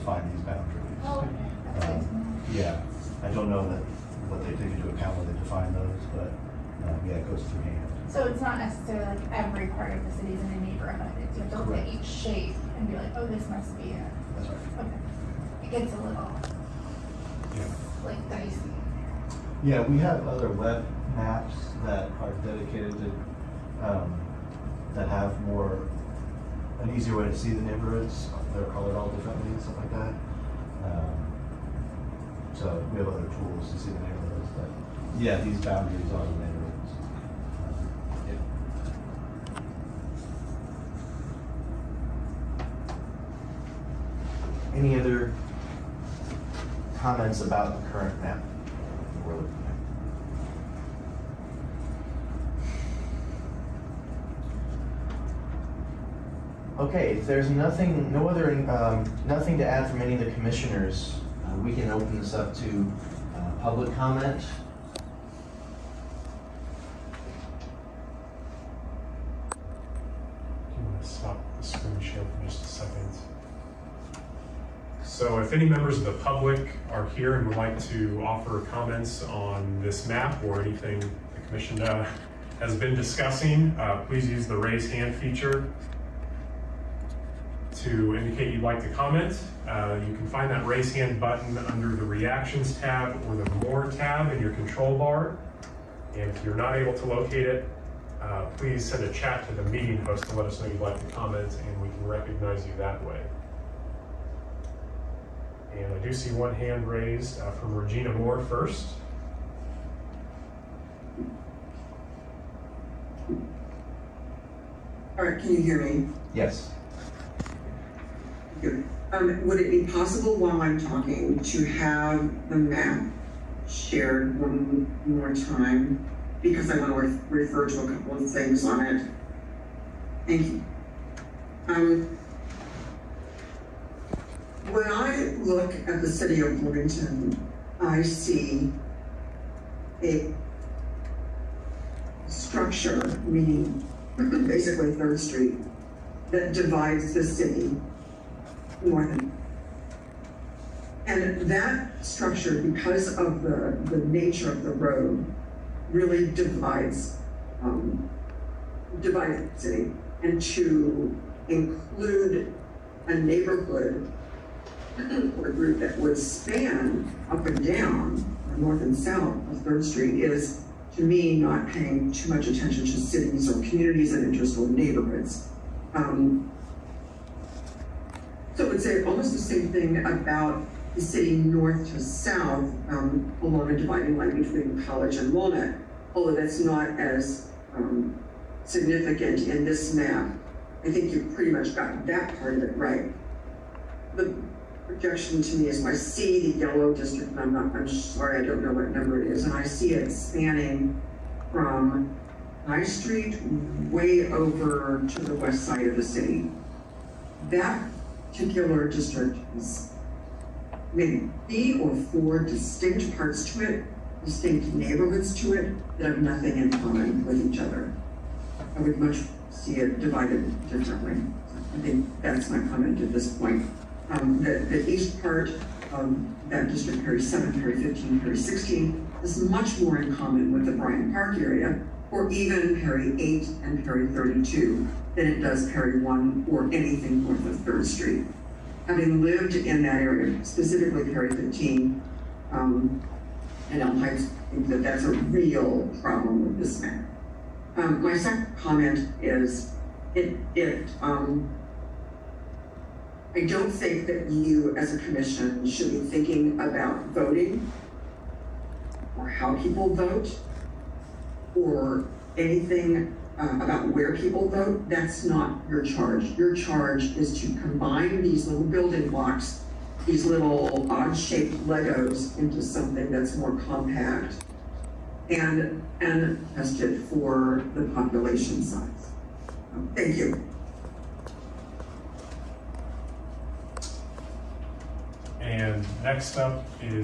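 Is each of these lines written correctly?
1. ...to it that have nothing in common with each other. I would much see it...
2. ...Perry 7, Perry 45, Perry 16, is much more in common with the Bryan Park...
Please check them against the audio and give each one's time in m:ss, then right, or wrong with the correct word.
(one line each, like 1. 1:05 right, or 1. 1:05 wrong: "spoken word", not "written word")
1. 3:35 right
2. 3:47 wrong: "15", not "45".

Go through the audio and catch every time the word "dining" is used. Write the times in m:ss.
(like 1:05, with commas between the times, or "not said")
not said.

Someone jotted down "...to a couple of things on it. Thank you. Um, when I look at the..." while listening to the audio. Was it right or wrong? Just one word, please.
right.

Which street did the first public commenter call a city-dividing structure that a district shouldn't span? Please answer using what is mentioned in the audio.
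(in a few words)
Third Street.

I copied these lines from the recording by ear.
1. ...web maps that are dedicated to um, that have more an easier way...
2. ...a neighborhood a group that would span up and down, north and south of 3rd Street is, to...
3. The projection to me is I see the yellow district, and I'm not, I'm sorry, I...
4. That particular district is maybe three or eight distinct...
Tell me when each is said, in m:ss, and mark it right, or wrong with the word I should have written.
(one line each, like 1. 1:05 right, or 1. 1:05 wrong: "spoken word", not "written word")
1. 0:20 right
2. 2:43 right
3. 3:14 right
4. 3:27 wrong: "four", not "eight".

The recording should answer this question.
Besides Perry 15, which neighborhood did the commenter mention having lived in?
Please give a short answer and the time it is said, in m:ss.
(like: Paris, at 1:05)
Elm Heights, at 4:03.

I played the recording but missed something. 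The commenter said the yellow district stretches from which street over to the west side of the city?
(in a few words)
High Street.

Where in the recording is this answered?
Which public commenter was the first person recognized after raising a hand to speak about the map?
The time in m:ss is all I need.
1:47.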